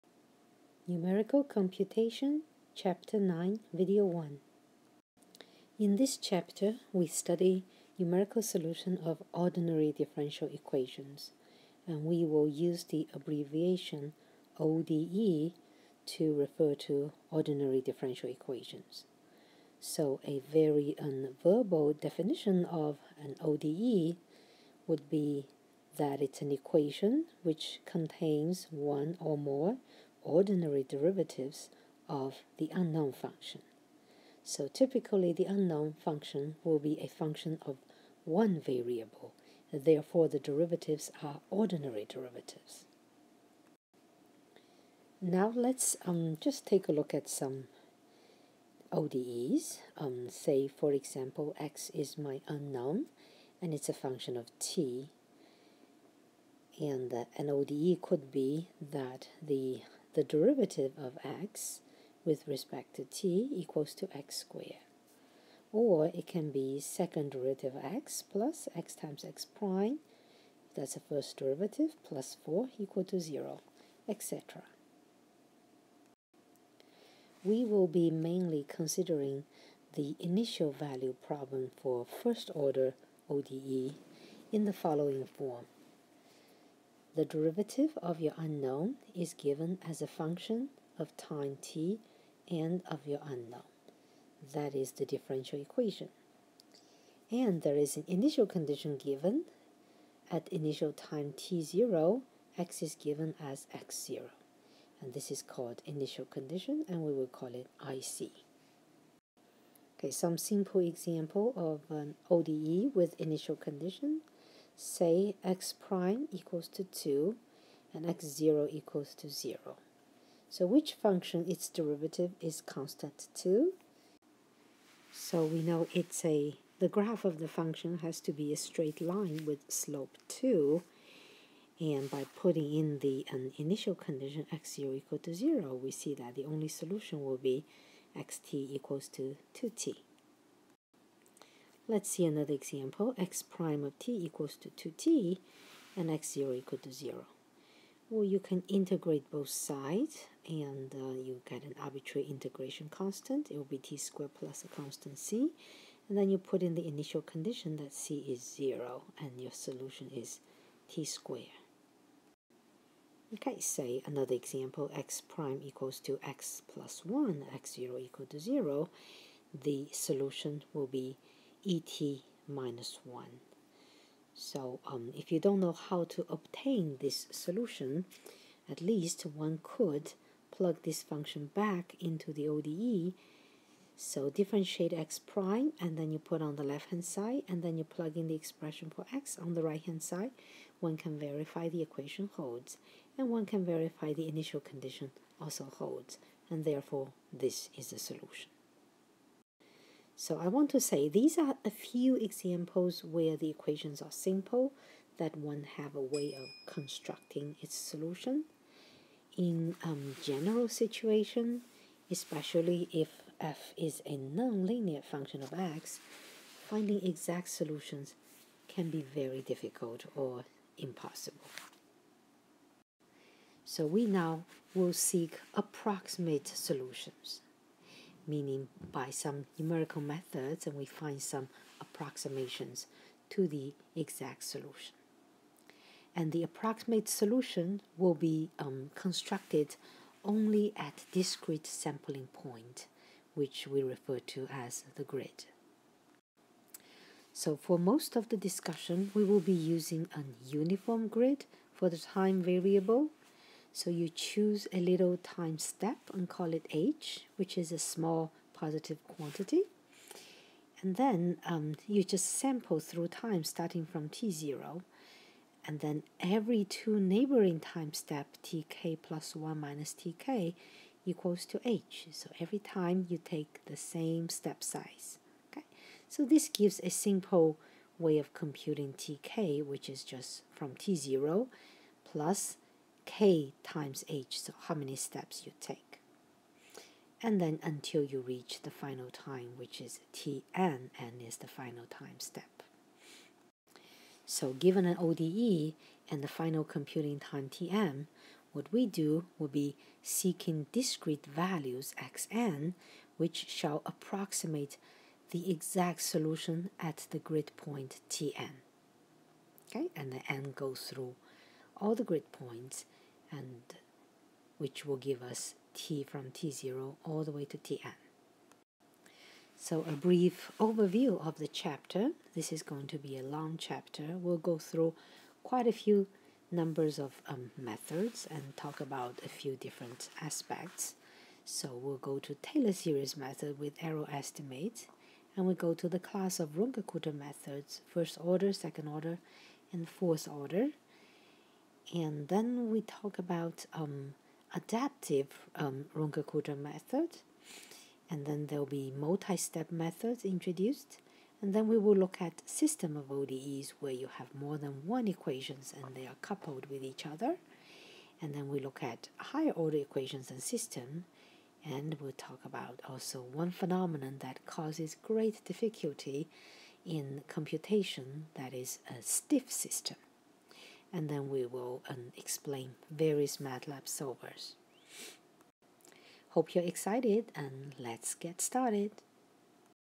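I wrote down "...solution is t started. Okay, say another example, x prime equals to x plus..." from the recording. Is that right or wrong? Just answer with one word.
wrong.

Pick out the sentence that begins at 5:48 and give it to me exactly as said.
And then there'll be multi-step methods introduced.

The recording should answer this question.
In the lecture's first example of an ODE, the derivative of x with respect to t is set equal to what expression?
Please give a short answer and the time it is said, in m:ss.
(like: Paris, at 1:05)
x squared, at 1:04.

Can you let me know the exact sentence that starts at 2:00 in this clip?
So which function its derivative is constant two?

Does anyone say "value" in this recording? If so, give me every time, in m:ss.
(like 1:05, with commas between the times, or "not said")
1:20, 5:01.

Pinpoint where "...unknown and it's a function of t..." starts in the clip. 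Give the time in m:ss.
0:52.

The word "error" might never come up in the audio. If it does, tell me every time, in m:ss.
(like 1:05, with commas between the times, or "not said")
5:33.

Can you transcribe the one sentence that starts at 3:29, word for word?
In um, general situation, especially if f is a nonlinear function of x, finding exact solutions can be very difficult or impossible.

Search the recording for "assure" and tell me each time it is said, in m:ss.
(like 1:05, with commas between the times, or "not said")
not said.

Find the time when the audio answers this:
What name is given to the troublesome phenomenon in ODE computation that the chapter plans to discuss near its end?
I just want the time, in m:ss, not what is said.
6:09.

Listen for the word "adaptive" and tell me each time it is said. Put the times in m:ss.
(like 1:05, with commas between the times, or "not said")
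5:44.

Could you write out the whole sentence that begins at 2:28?
Well, you can integrate both sides and uh, you get an arbitrary integration constant.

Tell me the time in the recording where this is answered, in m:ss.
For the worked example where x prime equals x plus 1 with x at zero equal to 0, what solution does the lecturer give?
2:51.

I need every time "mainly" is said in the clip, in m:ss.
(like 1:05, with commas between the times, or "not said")
1:18.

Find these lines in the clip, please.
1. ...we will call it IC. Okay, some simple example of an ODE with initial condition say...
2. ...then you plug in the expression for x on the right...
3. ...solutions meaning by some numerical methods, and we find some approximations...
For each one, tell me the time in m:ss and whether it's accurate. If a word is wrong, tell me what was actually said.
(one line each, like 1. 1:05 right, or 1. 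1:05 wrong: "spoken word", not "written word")
1. 1:47 right
2. 3:07 right
3. 3:46 right.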